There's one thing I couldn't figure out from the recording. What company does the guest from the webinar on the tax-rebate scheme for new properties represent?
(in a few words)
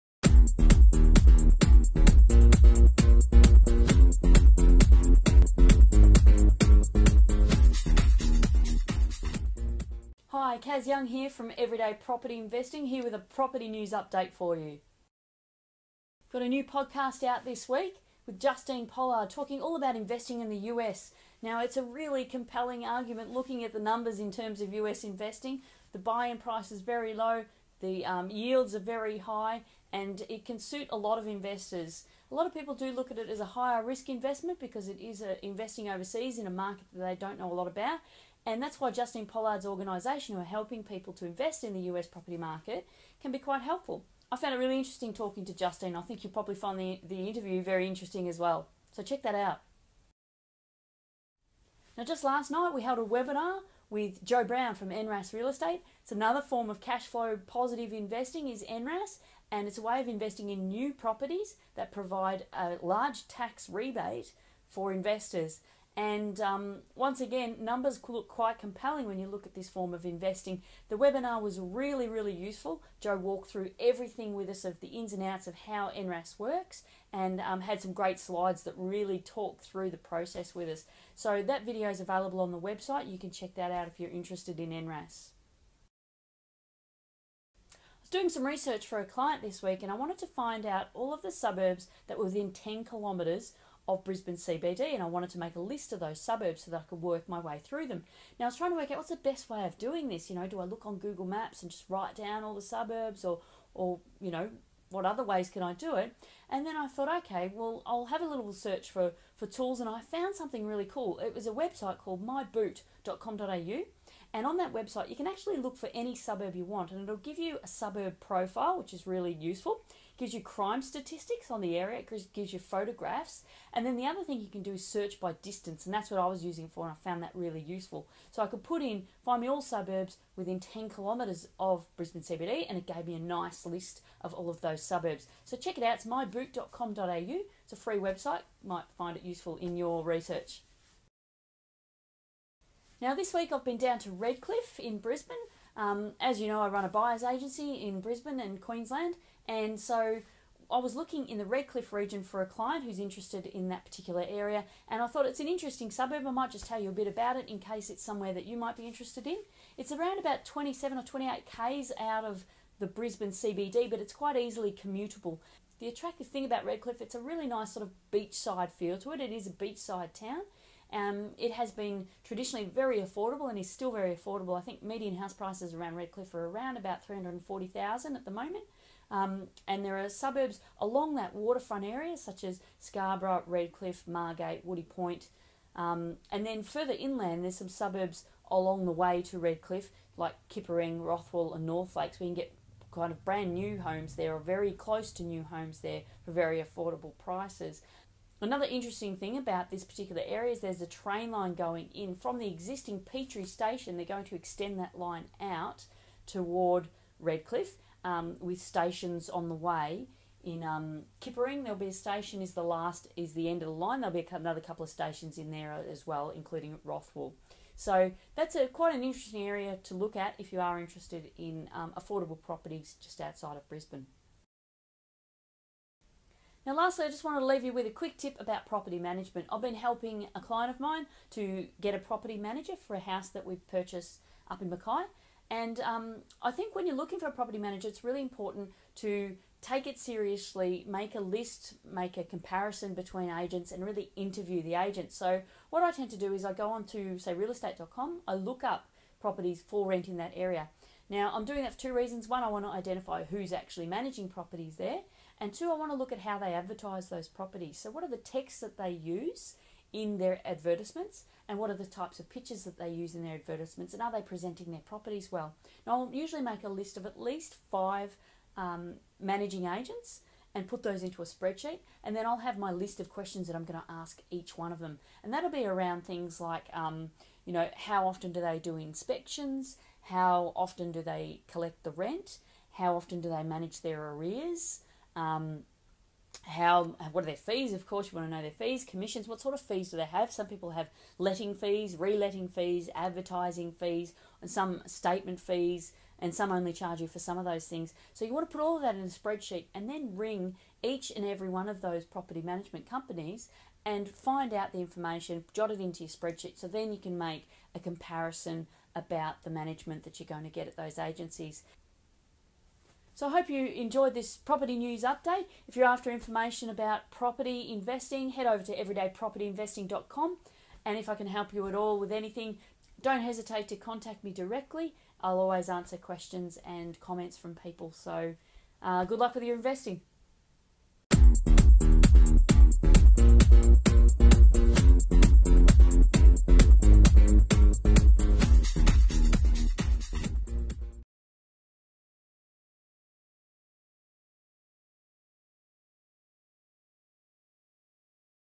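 NRAS Real Estate.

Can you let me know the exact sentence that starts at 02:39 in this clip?
It's around about 27 or 28 k's out of the Brisbane CBD, but it's quite easily commutable.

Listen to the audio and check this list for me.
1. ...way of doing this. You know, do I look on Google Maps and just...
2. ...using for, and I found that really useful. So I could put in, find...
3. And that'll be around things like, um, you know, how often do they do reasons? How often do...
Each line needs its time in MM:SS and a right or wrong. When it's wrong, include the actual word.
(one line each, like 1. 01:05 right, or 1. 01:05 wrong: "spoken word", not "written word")
1. 01:39 right
2. 02:06 right
3. 04:35 wrong: "inspections", not "reasons".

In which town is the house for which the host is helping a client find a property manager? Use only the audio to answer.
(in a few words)
Mackay.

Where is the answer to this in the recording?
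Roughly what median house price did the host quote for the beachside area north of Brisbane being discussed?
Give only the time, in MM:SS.
02:57.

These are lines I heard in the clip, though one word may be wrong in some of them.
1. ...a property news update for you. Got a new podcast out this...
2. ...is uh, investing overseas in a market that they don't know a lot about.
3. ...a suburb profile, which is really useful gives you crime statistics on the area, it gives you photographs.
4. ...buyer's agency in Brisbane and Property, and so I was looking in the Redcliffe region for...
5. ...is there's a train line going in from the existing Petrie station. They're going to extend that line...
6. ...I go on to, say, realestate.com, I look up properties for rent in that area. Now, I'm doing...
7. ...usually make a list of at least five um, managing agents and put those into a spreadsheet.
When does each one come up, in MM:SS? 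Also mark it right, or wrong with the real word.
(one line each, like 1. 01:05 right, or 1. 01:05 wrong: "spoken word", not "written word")
1. 00:13 right
2. 00:35 right
3. 01:57 right
4. 02:26 wrong: "Queensland", not "Property"
5. 03:20 right
6. 04:06 right
7. 04:26 right.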